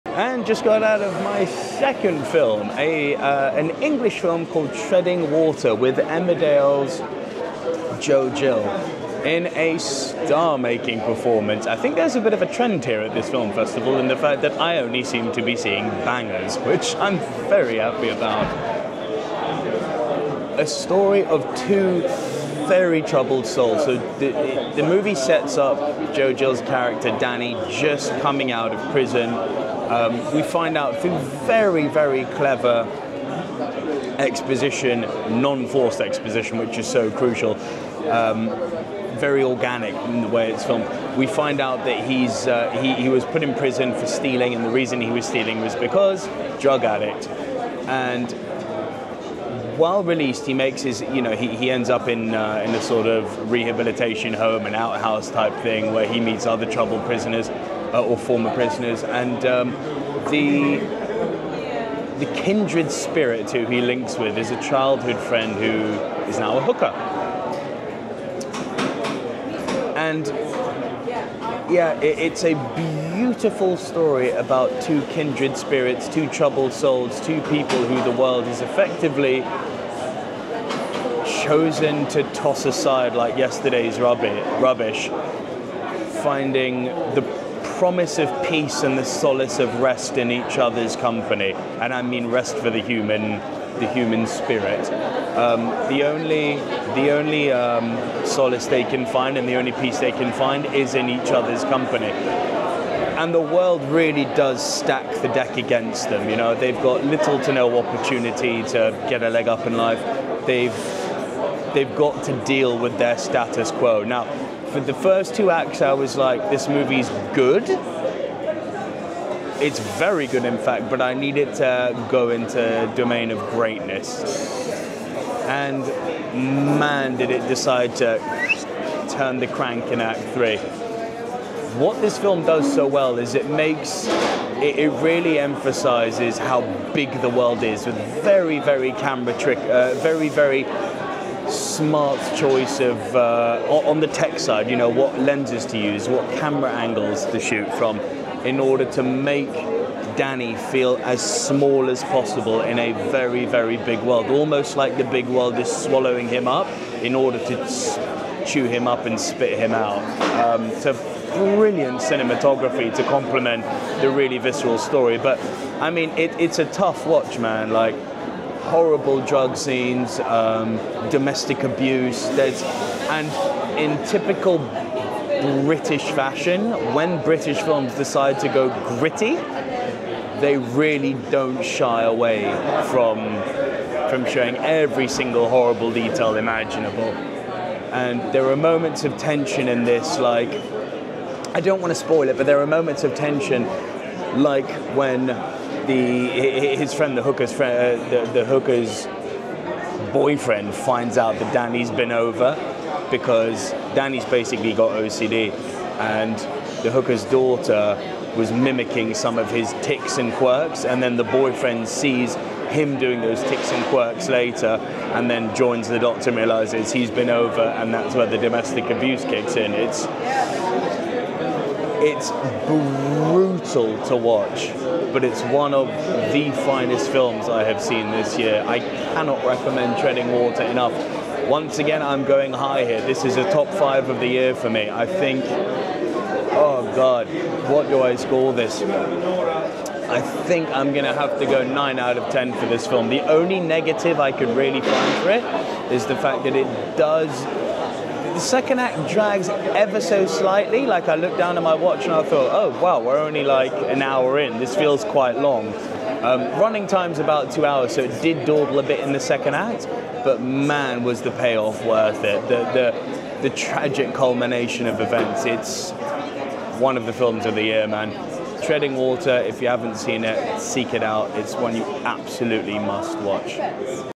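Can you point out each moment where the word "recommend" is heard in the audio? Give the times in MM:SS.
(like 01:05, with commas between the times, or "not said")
03:49.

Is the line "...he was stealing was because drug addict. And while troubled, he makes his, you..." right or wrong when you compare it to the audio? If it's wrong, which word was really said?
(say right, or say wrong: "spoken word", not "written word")
wrong: "released", not "troubled".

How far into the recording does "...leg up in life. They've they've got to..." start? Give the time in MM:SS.
01:49.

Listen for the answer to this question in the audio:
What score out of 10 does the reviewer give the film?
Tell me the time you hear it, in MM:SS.
04:01.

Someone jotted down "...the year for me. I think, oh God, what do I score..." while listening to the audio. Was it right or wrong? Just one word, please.
right.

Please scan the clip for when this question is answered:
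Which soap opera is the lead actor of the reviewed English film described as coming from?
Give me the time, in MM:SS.
00:05.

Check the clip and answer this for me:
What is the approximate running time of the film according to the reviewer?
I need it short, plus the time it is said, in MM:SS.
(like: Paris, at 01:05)
About 2 hours, at 04:17.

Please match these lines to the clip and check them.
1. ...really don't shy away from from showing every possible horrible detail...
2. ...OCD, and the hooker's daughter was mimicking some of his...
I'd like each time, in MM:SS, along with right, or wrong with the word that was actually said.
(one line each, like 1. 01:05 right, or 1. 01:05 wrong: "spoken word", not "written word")
1. 03:00 wrong: "single", not "possible"
2. 03:24 right.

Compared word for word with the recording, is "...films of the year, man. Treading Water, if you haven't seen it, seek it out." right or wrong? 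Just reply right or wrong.
right.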